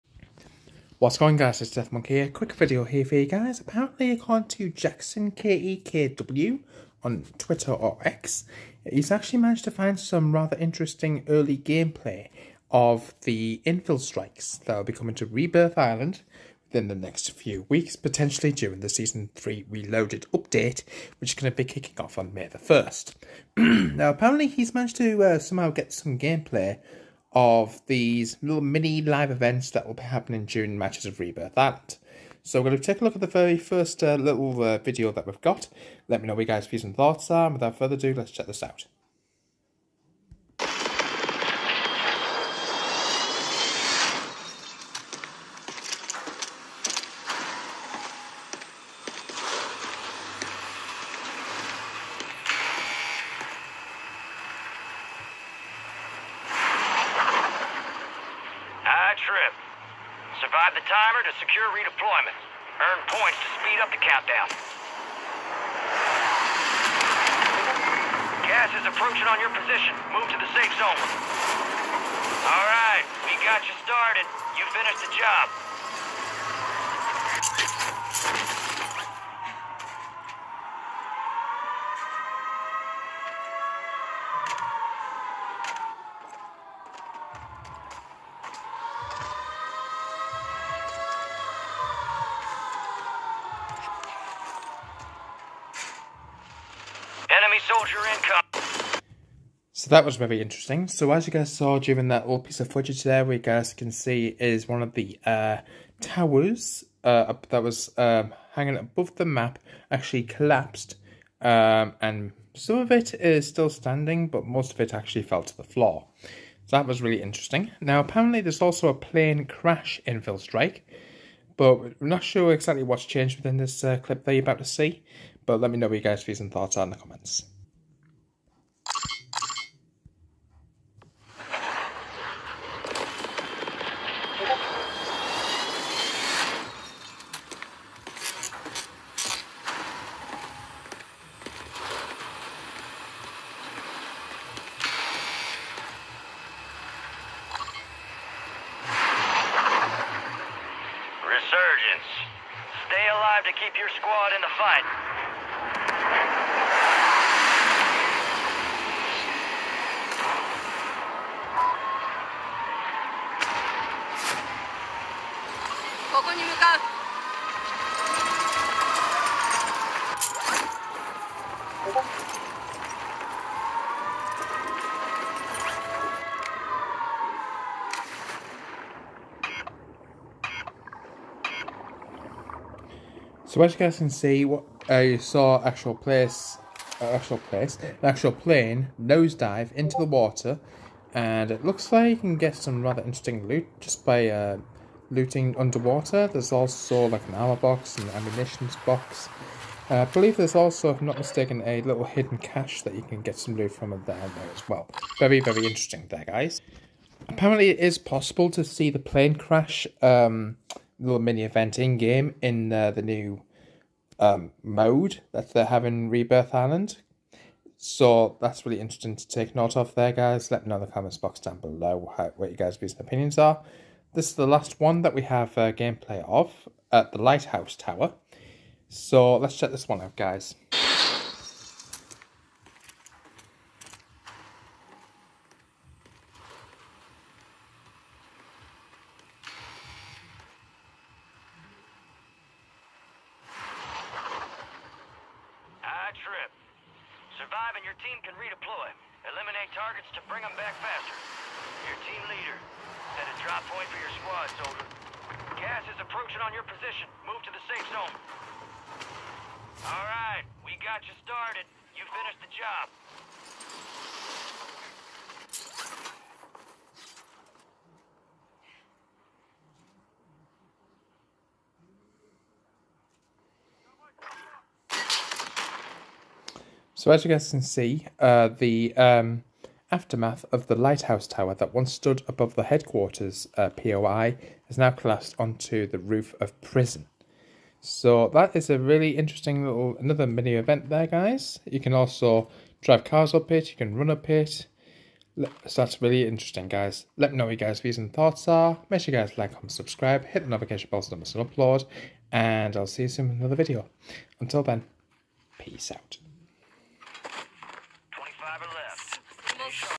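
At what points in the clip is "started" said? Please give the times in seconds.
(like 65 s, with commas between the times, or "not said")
73 s, 261 s.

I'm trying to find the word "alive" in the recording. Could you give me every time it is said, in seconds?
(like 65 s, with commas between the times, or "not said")
153 s.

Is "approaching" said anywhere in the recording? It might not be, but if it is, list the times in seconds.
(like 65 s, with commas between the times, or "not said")
68 s, 256 s.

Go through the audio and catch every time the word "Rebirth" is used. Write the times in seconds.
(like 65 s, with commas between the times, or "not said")
15 s, 31 s, 216 s.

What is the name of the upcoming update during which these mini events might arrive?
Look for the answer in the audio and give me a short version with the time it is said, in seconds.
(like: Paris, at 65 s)
Season 3 Reloaded, at 18 s.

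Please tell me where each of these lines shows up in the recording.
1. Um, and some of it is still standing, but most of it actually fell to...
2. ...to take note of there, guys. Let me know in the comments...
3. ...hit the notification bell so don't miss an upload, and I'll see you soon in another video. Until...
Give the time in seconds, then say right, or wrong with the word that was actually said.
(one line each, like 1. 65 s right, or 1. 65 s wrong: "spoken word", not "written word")
1. 111 s right
2. 219 s right
3. 300 s right.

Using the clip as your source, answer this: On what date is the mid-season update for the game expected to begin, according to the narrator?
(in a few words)
May 1st.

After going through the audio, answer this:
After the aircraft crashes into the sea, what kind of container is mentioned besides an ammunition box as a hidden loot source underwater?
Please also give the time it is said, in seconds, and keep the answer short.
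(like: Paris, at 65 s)
cache, at 202 s.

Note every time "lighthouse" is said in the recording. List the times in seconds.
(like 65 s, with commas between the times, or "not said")
227 s, 280 s.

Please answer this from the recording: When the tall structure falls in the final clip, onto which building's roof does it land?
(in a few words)
prison.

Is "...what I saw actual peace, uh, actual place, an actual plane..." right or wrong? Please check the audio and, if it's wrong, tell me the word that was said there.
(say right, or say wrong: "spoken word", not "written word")
wrong: "place", not "peace".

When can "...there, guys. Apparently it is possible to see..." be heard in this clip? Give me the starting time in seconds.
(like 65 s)
206 s.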